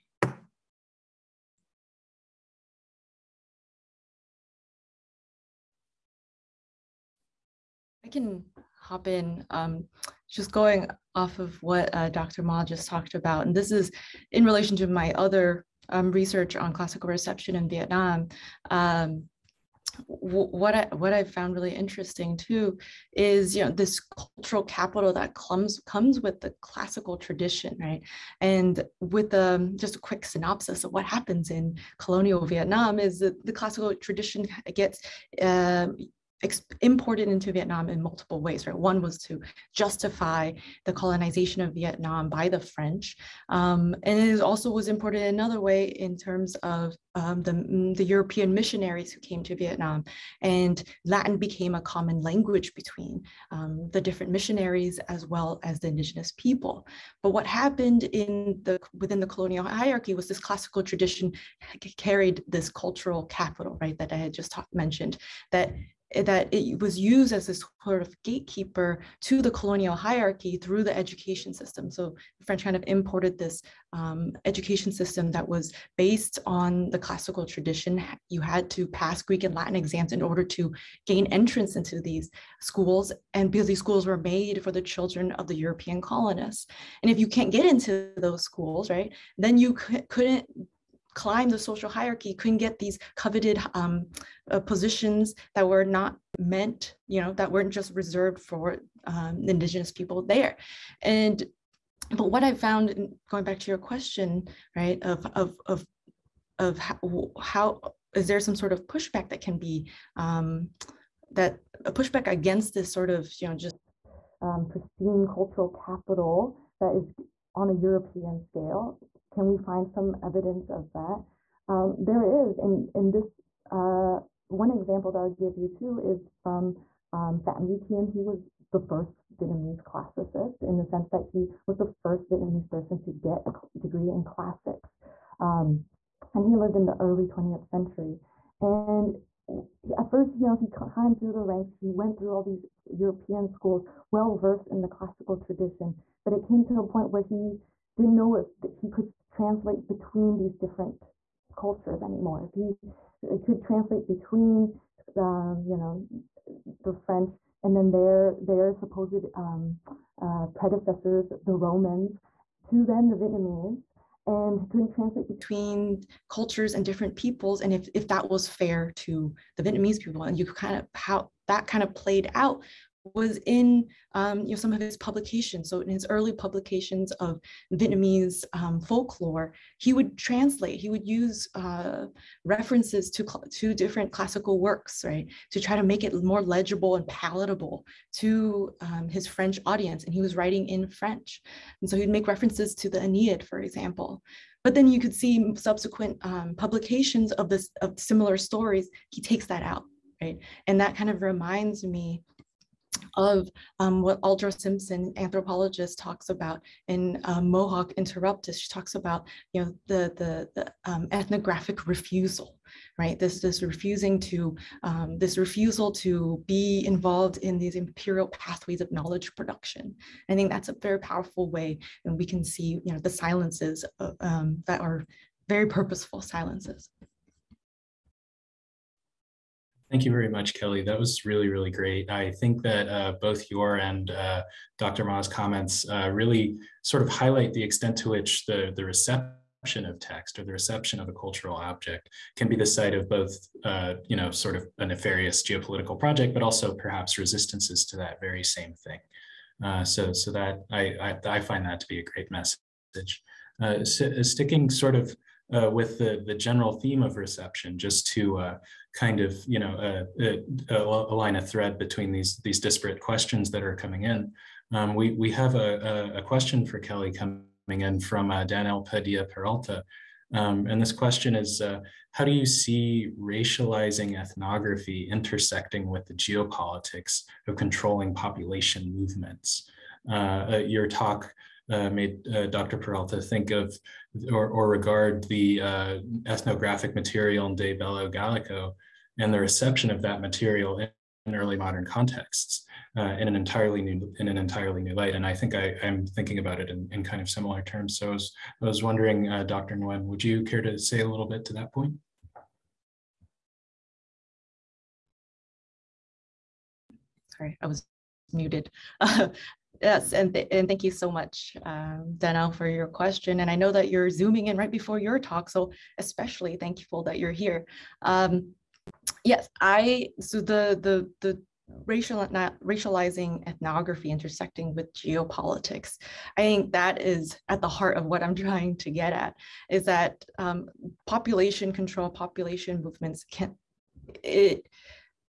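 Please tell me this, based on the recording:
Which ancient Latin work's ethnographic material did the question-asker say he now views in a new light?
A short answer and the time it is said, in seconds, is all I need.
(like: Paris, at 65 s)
De Bello Gallico, at 287 s.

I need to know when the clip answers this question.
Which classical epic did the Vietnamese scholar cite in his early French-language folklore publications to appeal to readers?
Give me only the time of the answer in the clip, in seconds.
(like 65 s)
192 s.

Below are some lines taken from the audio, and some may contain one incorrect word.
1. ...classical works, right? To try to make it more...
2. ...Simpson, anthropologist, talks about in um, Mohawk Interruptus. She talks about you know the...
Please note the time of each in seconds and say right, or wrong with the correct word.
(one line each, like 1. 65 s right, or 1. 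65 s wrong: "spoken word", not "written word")
1. 184 s right
2. 204 s right.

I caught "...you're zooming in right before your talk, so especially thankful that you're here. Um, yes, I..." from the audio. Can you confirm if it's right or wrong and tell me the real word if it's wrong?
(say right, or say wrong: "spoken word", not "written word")
right.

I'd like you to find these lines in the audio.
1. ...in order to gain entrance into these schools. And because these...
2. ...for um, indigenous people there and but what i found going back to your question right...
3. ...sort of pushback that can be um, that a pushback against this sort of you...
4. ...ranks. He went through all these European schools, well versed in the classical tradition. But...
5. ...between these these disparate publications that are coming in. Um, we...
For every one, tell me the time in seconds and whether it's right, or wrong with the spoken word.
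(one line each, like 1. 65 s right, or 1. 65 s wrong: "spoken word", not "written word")
1. 80 s right
2. 98 s right
3. 108 s right
4. 141 s right
5. 261 s wrong: "questions", not "publications".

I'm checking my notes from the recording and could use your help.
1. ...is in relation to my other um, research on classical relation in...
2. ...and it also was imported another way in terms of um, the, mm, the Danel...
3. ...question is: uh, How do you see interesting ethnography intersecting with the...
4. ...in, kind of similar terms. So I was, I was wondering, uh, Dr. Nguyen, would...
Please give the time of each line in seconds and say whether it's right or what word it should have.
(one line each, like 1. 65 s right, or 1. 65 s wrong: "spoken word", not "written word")
1. 13 s wrong: "reception", not "relation"
2. 44 s wrong: "European", not "Danel"
3. 270 s wrong: "racializing", not "interesting"
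4. 296 s right.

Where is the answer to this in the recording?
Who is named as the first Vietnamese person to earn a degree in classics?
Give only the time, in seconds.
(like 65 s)
127 s.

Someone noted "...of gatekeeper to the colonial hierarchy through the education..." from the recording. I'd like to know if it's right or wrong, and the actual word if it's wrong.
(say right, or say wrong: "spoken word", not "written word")
right.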